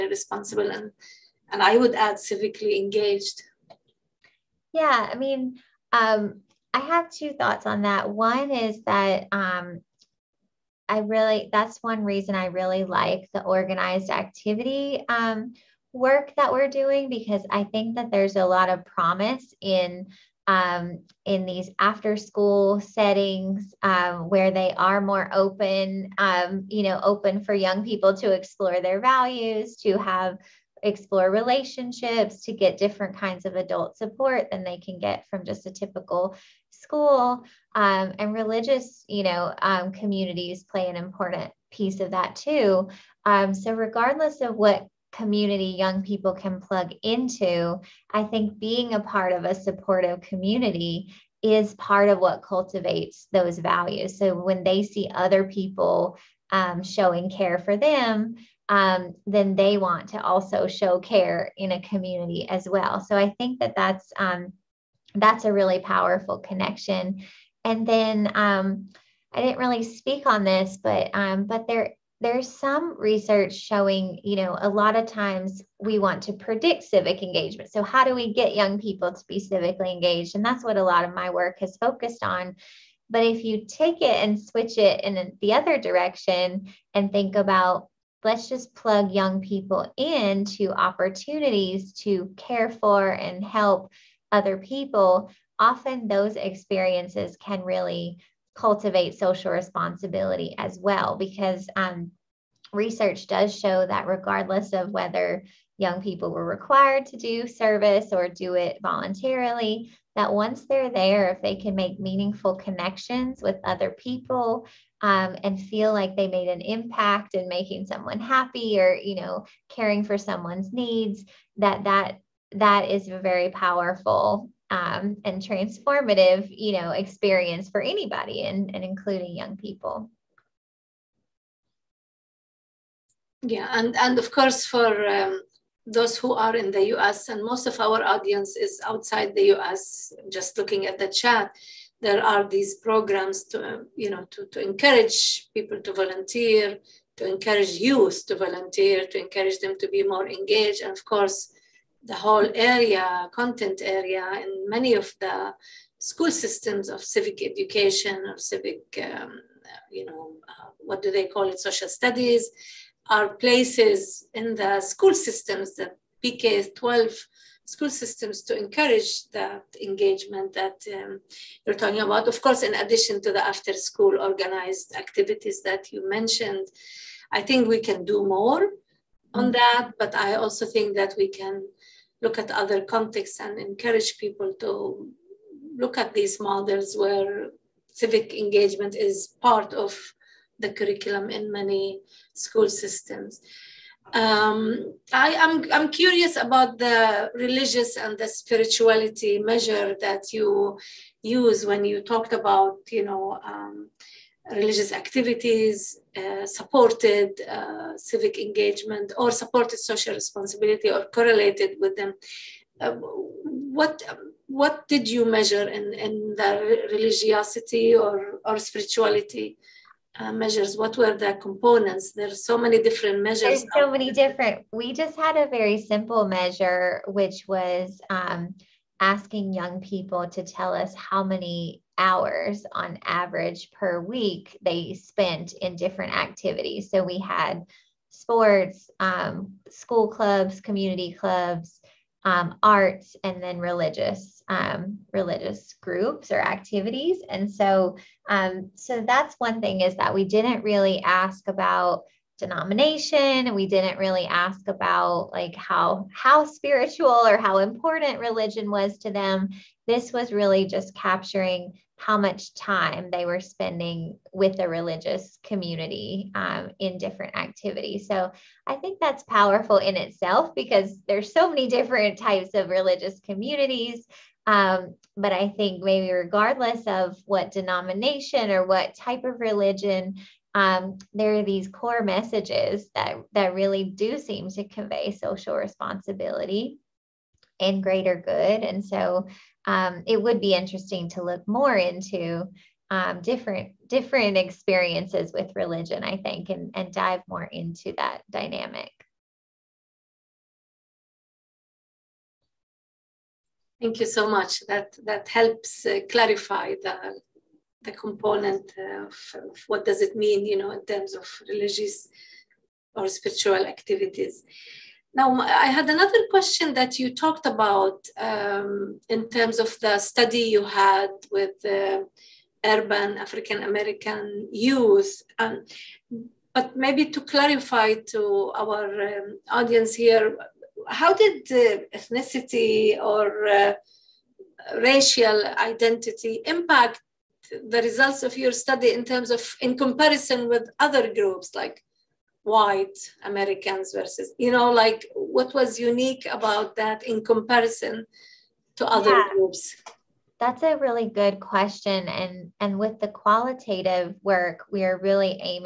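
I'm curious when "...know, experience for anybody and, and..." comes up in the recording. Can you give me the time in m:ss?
2:06.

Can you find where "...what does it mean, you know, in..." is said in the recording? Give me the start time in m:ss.
5:09.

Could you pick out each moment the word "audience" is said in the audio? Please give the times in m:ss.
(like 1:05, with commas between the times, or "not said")
2:18, 5:29.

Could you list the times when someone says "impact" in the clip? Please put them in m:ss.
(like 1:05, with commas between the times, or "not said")
1:56, 5:36.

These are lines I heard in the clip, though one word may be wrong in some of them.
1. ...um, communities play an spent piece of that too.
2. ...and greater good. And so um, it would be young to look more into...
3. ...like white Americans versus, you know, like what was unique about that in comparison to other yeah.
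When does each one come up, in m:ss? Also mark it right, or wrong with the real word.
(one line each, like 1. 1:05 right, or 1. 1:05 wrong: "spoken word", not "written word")
1. 0:39 wrong: "important", not "spent"
2. 4:47 wrong: "interesting", not "young"
3. 5:41 right.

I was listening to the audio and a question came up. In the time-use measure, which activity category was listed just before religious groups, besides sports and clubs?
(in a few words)
Arts.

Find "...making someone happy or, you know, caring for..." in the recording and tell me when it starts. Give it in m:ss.
1:57.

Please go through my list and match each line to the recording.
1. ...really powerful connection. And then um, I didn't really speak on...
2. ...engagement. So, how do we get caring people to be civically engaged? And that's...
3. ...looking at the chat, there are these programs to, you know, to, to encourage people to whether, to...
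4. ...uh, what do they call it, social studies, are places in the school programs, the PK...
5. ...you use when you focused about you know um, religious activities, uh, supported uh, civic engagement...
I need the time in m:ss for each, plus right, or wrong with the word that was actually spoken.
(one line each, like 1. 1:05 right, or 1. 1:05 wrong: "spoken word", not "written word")
1. 1:05 right
2. 1:17 wrong: "young", not "caring"
3. 2:20 wrong: "volunteer", not "whether"
4. 2:40 wrong: "systems", not "programs"
5. 3:20 wrong: "talked", not "focused".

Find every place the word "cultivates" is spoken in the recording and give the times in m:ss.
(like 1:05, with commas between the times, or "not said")
0:52, 1:38.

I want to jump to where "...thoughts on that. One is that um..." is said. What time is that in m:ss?
0:07.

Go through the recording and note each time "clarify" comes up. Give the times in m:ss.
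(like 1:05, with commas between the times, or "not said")
5:06, 5:27.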